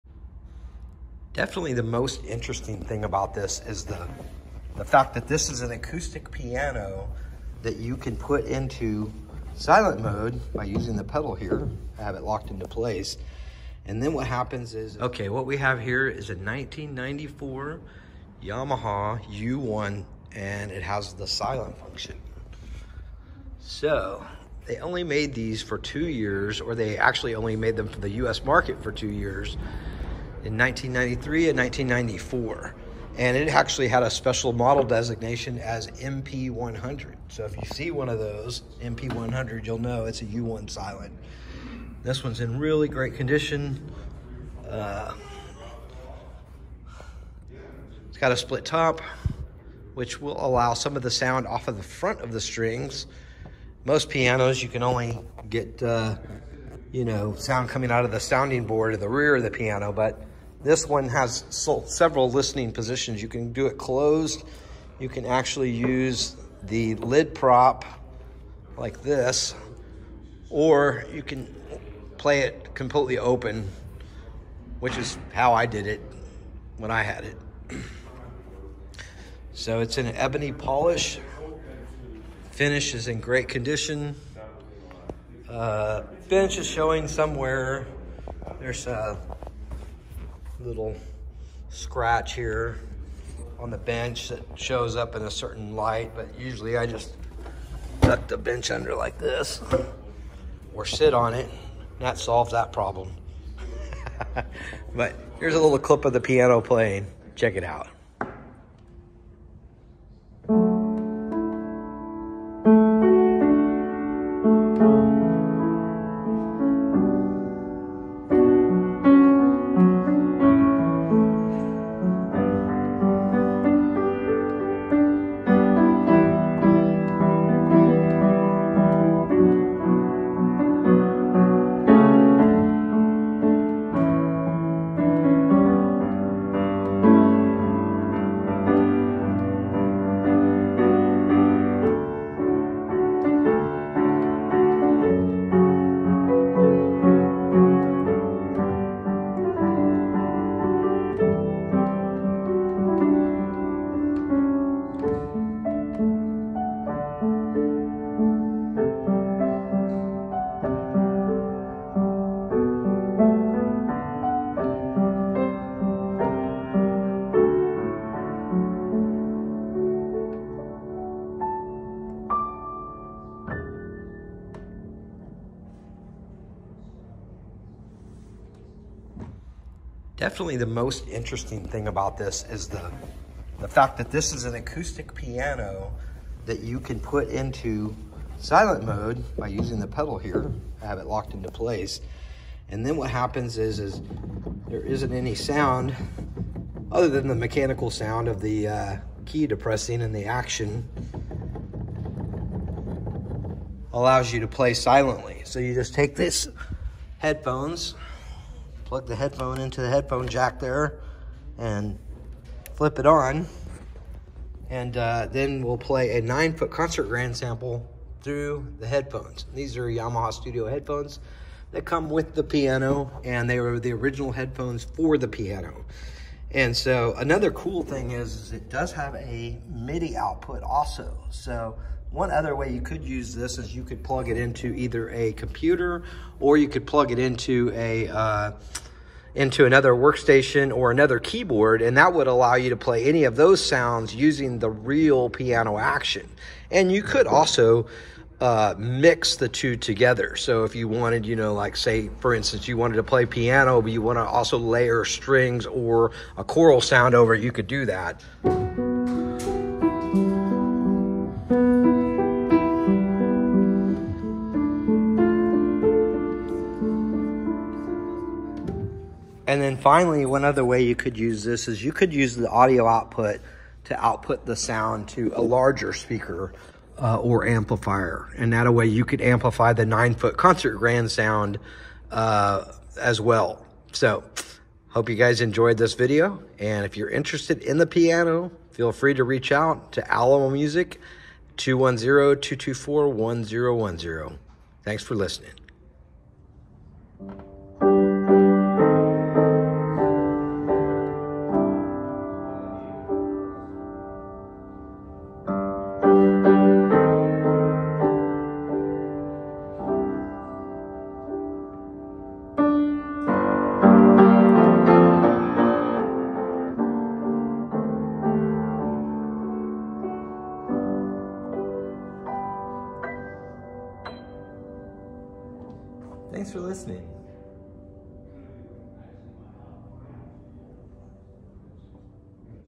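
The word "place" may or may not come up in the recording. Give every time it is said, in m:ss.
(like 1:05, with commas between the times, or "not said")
0:12, 3:11.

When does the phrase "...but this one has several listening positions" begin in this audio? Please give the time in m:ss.
0:59.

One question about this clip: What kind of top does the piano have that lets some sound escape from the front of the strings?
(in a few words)
split top.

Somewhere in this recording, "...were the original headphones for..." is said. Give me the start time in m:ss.
3:43.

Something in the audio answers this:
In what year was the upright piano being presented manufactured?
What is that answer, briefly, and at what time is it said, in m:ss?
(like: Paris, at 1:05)
1994, at 0:16.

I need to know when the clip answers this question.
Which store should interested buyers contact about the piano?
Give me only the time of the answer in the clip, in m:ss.
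4:50.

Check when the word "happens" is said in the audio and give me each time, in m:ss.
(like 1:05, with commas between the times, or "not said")
0:14, 3:13.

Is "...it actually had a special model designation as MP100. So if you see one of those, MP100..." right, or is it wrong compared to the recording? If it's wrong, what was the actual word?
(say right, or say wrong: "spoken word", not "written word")
right.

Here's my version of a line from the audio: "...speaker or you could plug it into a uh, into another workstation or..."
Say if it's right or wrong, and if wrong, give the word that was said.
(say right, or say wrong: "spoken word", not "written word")
wrong: "computer", not "speaker".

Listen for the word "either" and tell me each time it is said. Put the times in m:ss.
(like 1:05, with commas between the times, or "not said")
3:54.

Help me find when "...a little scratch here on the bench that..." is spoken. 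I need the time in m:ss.
1:28.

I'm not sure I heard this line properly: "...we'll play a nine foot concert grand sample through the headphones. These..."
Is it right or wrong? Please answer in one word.
right.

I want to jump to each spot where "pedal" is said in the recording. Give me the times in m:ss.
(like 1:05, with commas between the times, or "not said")
0:11, 3:09.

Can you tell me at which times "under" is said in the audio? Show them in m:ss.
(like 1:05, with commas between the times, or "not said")
1:38.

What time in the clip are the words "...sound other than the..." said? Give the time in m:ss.
3:15.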